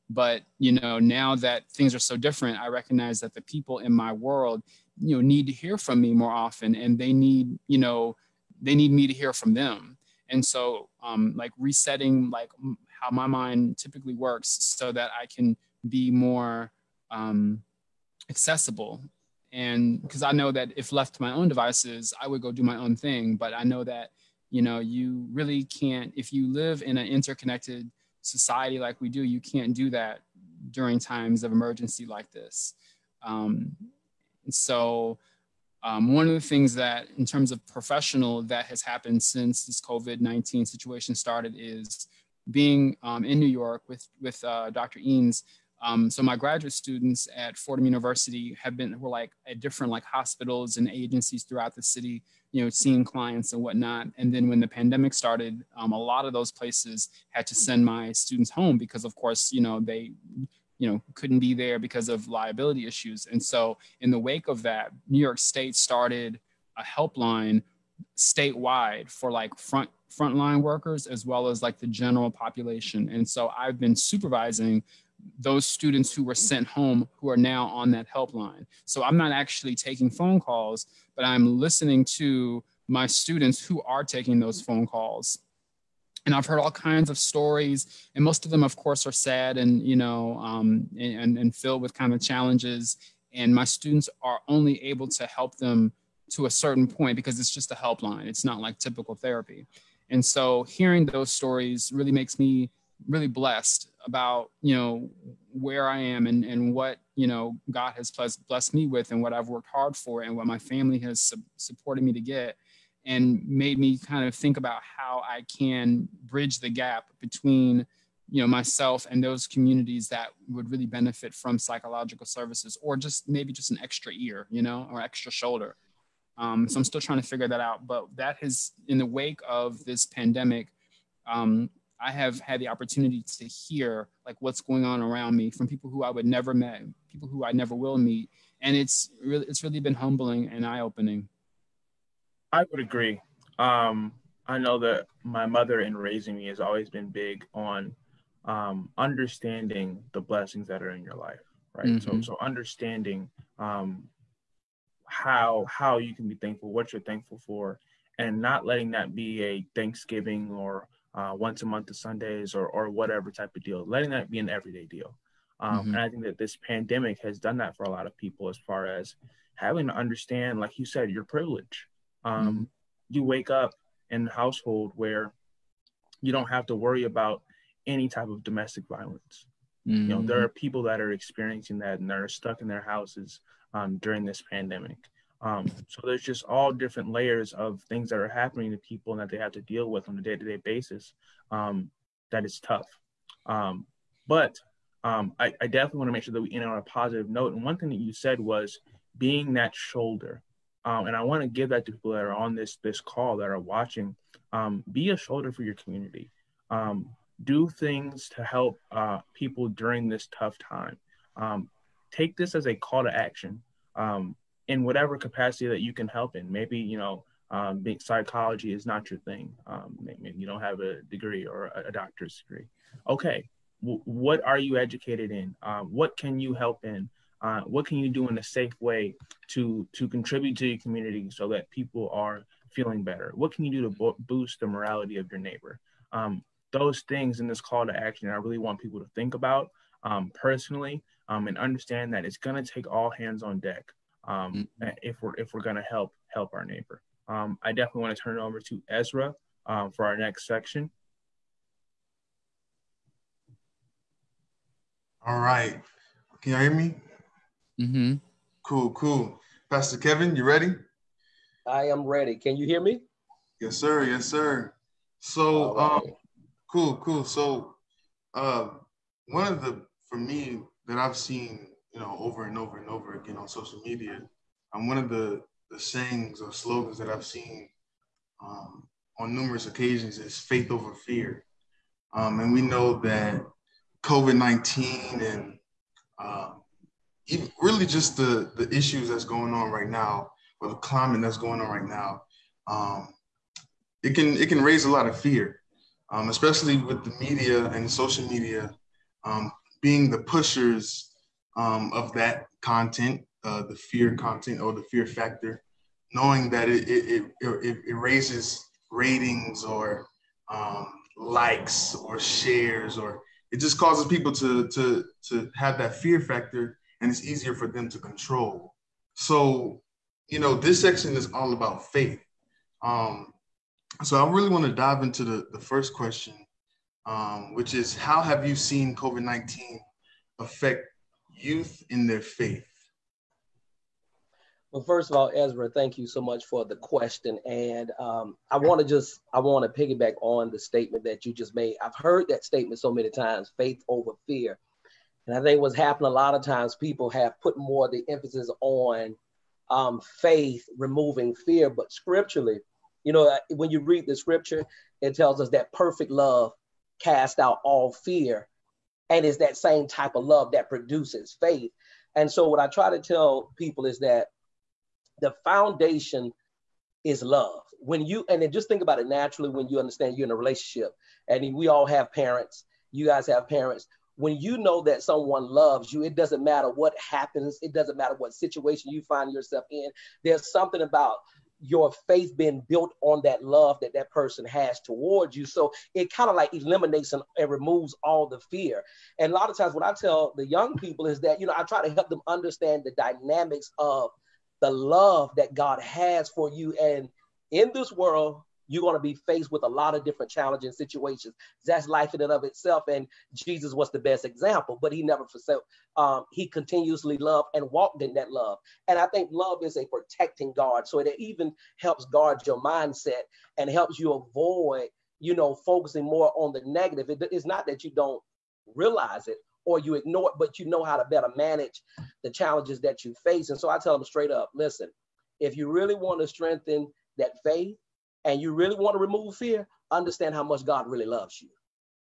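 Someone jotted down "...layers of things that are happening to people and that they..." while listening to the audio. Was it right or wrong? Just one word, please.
right.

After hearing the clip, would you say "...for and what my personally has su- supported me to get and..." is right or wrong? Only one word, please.
wrong.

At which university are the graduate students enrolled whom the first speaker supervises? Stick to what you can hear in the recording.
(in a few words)
Fordham University.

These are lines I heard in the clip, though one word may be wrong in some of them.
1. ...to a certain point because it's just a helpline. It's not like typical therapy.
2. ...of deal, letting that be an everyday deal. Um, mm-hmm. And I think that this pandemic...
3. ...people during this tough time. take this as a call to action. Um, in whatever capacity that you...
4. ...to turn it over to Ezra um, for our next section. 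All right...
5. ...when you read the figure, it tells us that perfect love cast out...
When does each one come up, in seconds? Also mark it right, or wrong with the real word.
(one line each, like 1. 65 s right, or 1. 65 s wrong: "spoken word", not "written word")
1. 96 s right
2. 163 s right
3. 209 s right
4. 248 s right
5. 353 s wrong: "scripture", not "figure".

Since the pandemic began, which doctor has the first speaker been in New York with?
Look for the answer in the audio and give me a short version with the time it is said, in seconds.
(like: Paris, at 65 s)
Dr. Eanes, at 44 s.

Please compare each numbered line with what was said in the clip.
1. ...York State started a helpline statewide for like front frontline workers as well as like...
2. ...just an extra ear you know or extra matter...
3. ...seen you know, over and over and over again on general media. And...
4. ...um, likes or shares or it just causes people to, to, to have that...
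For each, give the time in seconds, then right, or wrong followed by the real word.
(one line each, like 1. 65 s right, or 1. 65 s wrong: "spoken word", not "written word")
1. 65 s right
2. 123 s wrong: "shoulder", not "matter"
3. 271 s wrong: "social", not "general"
4. 310 s right.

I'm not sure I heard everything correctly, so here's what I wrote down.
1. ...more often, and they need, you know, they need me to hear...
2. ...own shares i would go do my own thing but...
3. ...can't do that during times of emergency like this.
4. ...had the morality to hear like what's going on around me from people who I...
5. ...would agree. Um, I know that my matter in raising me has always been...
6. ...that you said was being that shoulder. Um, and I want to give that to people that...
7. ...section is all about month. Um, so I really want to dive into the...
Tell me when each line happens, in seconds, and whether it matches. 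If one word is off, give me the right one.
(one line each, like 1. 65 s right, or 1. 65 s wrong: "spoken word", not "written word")
1. 6 s right
2. 21 s wrong: "devices", not "shares"
3. 29 s right
4. 132 s wrong: "opportunity", not "morality"
5. 142 s wrong: "mother", not "matter"
6. 197 s right
7. 320 s wrong: "faith", not "month".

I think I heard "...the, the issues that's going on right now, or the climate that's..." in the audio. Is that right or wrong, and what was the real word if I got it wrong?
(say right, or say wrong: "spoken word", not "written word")
right.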